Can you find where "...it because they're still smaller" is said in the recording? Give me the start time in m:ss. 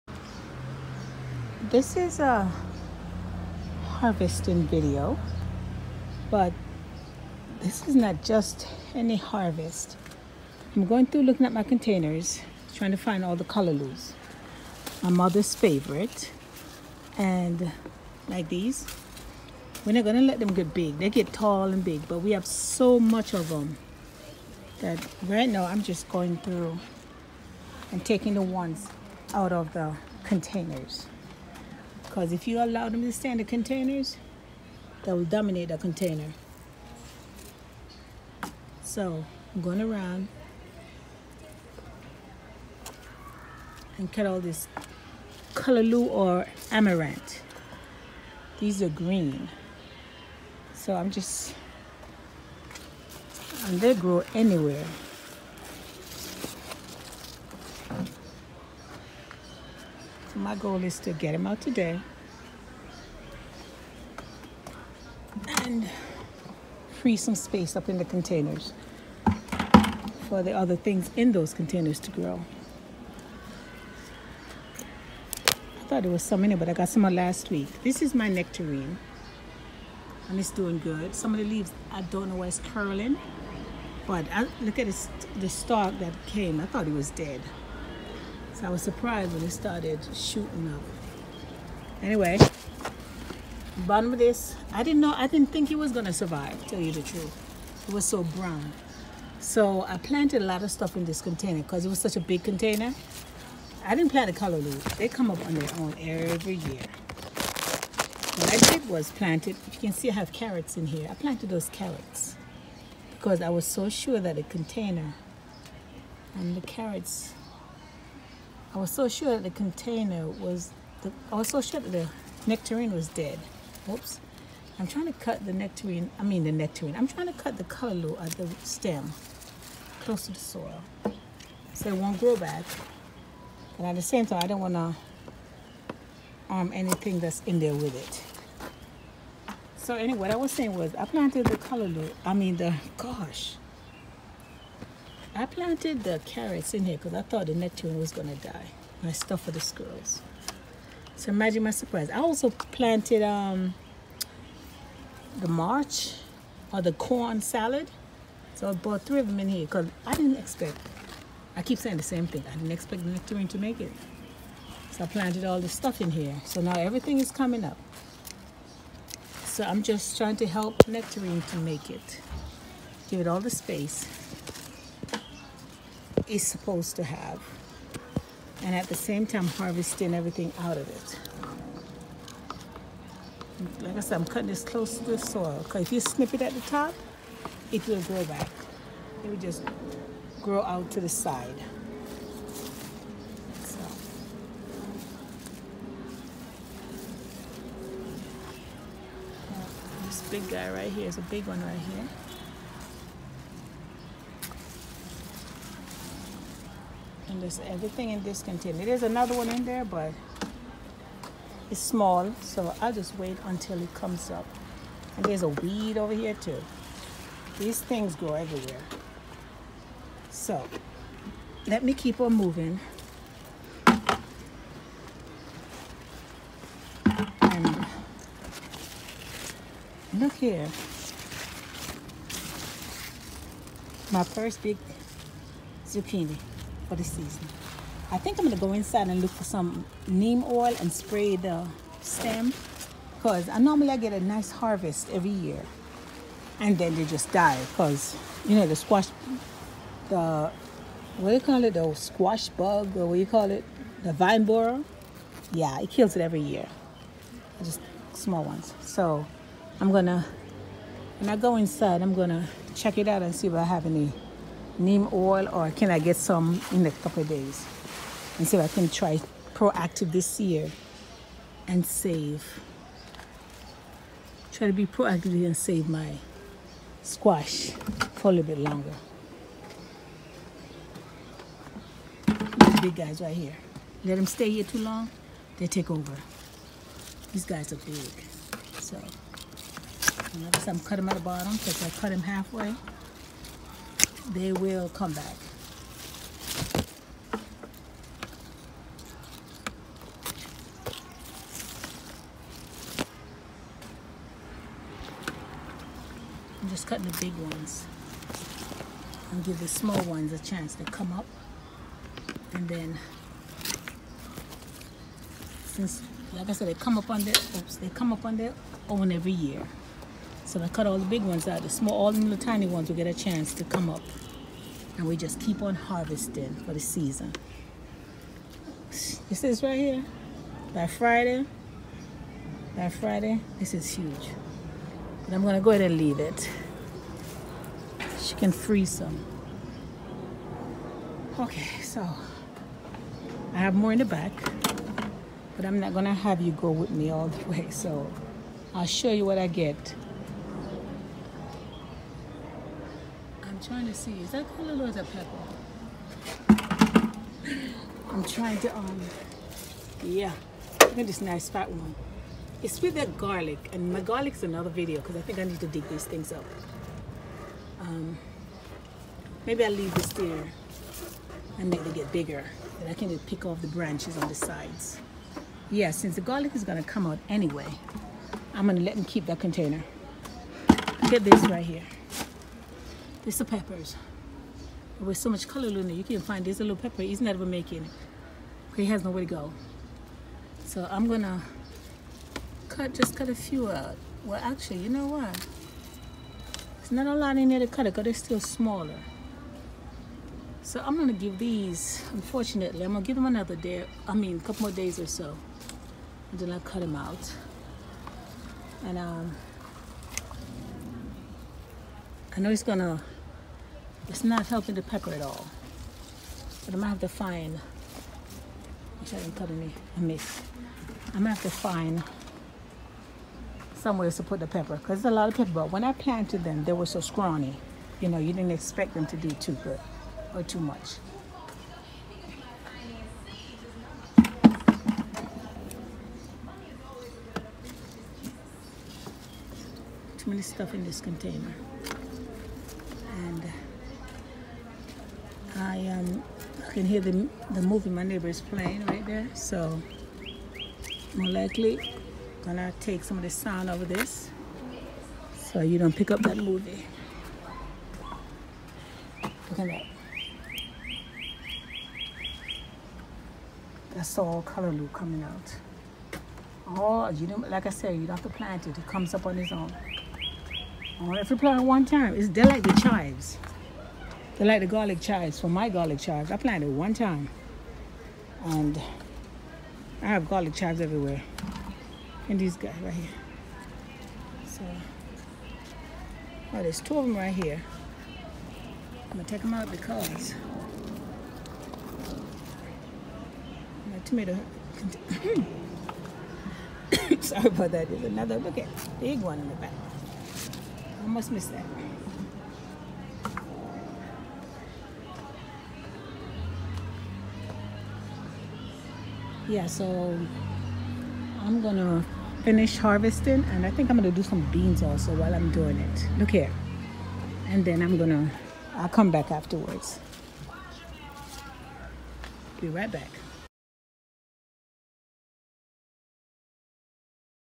6:37.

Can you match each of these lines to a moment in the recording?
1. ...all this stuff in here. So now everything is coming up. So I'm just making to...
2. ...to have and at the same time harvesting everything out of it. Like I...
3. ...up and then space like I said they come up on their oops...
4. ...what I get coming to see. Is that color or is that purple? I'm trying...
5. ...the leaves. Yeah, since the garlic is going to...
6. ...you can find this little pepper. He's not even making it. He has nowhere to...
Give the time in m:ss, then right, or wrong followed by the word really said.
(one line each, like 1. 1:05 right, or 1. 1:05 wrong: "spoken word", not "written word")
1. 2:45 wrong: "trying", not "making"
2. 2:56 right
3. 5:11 wrong: "since", not "space"
4. 5:49 wrong: "trying", not "coming"
5. 6:14 wrong: "sides", not "leaves"
6. 6:25 right.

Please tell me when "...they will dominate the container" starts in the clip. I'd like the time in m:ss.
0:35.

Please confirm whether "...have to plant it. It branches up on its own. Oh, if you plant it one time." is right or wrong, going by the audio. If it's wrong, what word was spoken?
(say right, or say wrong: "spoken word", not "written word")
wrong: "comes", not "branches".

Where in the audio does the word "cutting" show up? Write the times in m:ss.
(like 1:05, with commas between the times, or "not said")
3:04, 4:50, 5:06.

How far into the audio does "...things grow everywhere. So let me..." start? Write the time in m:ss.
3:37.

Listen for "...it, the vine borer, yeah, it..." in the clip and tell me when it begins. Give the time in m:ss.
4:13.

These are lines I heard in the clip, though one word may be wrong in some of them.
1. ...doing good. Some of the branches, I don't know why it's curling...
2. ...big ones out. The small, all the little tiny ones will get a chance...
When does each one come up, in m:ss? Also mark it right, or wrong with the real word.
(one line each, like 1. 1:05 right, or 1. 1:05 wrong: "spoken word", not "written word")
1. 1:20 wrong: "leaves", not "branches"
2. 5:21 right.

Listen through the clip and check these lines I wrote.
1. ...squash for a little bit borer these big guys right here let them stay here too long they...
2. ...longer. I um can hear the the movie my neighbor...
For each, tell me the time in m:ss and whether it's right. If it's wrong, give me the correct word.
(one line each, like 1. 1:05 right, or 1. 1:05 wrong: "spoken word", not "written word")
1. 4:37 wrong: "longer", not "borer"
2. 7:20 wrong: "container", not "longer".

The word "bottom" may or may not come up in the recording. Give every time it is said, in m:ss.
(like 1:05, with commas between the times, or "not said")
1:33, 4:51.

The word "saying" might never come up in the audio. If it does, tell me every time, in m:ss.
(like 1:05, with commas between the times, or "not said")
2:20, 2:41.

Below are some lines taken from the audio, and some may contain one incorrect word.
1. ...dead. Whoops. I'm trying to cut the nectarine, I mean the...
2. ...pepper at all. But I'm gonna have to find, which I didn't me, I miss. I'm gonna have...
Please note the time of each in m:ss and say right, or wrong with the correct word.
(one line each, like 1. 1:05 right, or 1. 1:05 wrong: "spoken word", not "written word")
1. 2:03 right
2. 6:54 right.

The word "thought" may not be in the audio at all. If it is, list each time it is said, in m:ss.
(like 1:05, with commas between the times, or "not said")
1:15, 1:26, 2:27.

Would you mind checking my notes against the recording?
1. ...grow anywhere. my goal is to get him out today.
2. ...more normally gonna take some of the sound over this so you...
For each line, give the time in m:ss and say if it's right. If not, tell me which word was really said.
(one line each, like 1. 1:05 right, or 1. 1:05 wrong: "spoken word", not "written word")
1. 0:53 right
2. 7:31 wrong: "likely", not "normally".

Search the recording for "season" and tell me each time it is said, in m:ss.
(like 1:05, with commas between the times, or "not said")
3:57, 5:26.